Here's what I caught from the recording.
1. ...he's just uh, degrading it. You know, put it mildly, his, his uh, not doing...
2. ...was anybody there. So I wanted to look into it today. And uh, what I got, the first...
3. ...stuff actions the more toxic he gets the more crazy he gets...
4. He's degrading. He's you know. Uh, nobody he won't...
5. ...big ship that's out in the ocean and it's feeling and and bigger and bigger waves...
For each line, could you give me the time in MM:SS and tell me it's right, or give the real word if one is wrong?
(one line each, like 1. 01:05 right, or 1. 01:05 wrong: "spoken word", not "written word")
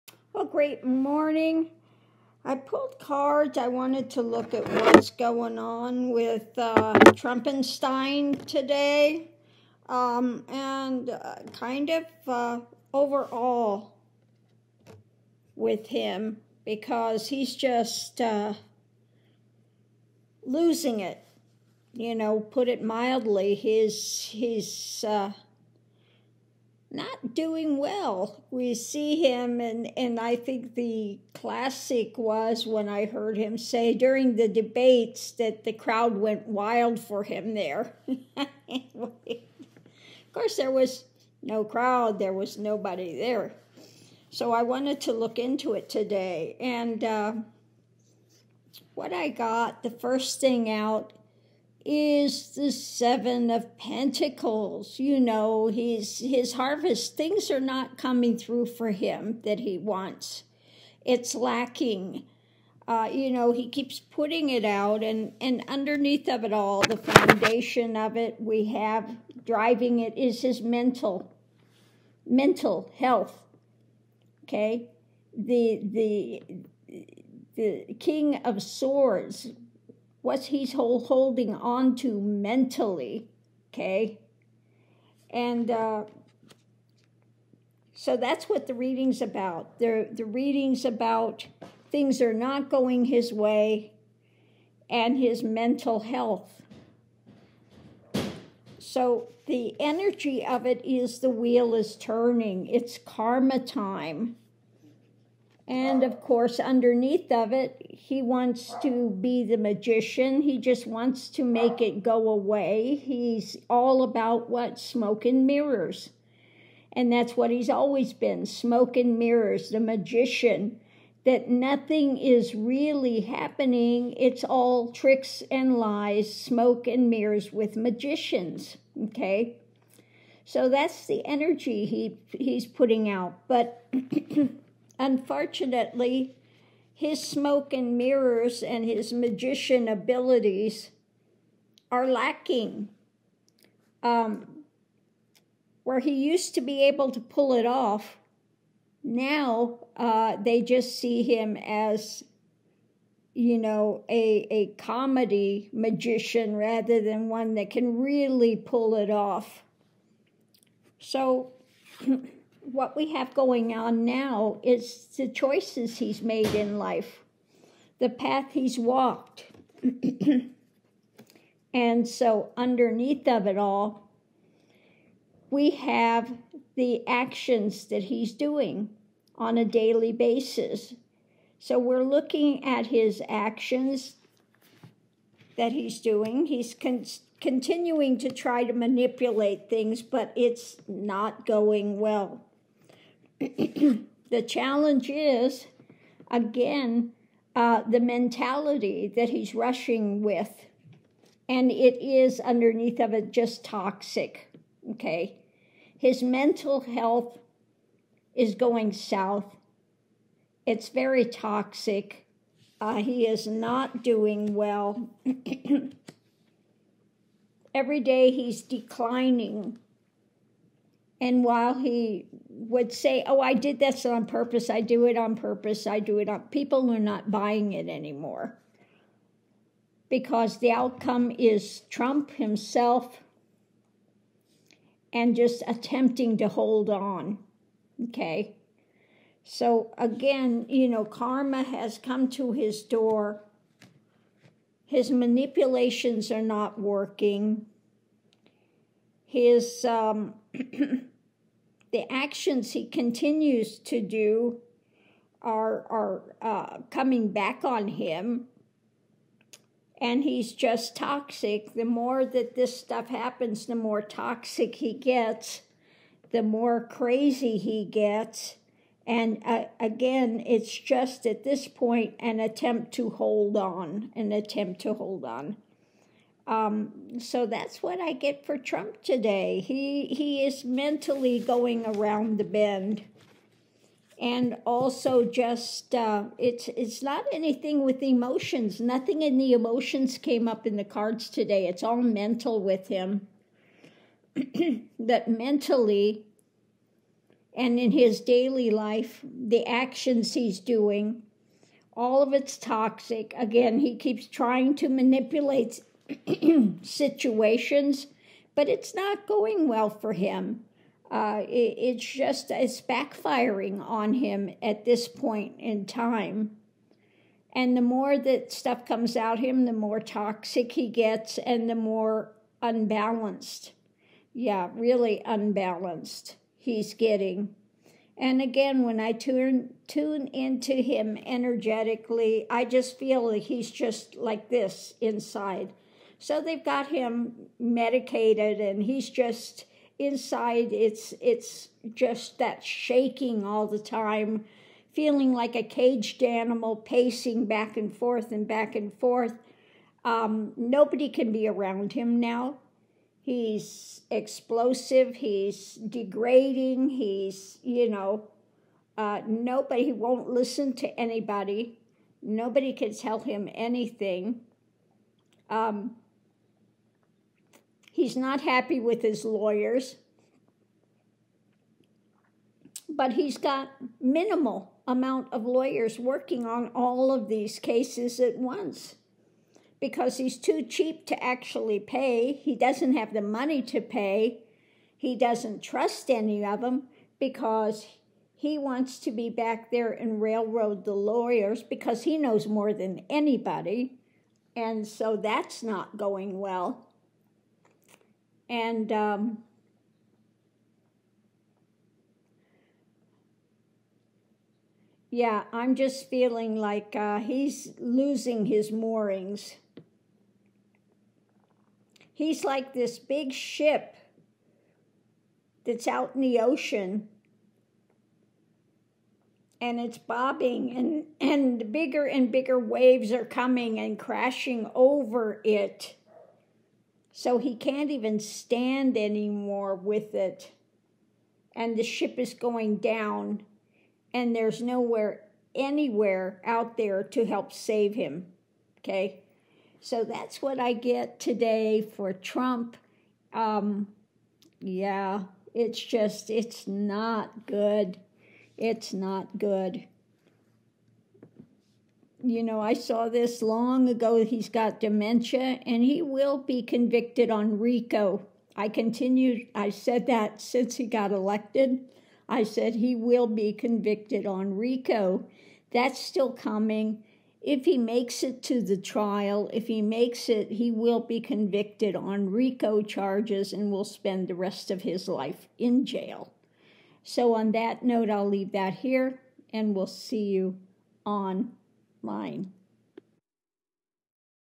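1. 00:17 wrong: "losing", not "degrading"
2. 00:42 wrong: "nobody", not "anybody"
3. 04:22 wrong: "happens", not "actions"
4. 05:55 right
5. 06:52 wrong: "bobbing", not "feeling".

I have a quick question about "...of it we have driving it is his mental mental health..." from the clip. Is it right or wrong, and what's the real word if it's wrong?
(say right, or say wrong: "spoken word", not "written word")
right.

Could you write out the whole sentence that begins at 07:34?
He's got dementia and he will be convicted on RICO.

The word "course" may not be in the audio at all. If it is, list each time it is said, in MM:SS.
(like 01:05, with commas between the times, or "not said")
00:40, 01:46.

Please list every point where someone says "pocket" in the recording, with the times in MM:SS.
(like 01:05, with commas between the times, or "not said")
not said.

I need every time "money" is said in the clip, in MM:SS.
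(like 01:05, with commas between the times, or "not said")
06:23.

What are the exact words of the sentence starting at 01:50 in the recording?
He just wants to make it go away.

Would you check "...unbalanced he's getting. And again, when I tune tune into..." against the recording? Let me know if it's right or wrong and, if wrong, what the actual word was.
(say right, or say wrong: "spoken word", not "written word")
right.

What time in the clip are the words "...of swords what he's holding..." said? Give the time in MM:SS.
01:18.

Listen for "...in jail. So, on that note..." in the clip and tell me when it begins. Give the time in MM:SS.
07:55.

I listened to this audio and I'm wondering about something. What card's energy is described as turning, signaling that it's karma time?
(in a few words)
The Wheel.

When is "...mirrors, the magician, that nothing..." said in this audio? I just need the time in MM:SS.
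01:59.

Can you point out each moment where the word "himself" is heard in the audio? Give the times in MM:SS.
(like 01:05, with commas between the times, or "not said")
03:52.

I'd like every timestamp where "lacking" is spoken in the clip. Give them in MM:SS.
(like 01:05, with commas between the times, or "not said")
01:01, 02:22.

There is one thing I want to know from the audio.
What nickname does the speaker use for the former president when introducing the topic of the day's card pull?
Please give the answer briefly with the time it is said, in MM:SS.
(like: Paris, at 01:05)
Trumpenstein, at 00:07.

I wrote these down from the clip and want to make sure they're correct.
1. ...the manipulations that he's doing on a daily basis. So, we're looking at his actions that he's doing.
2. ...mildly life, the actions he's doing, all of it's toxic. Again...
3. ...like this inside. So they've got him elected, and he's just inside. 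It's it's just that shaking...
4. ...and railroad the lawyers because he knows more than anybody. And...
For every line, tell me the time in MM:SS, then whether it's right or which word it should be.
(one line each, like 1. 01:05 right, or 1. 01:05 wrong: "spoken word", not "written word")
1. 02:56 wrong: "actions", not "manipulations"
2. 04:58 wrong: "daily", not "mildly"
3. 05:34 wrong: "medicated", not "elected"
4. 06:29 right.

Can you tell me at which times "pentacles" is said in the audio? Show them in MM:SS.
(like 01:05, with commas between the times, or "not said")
00:53.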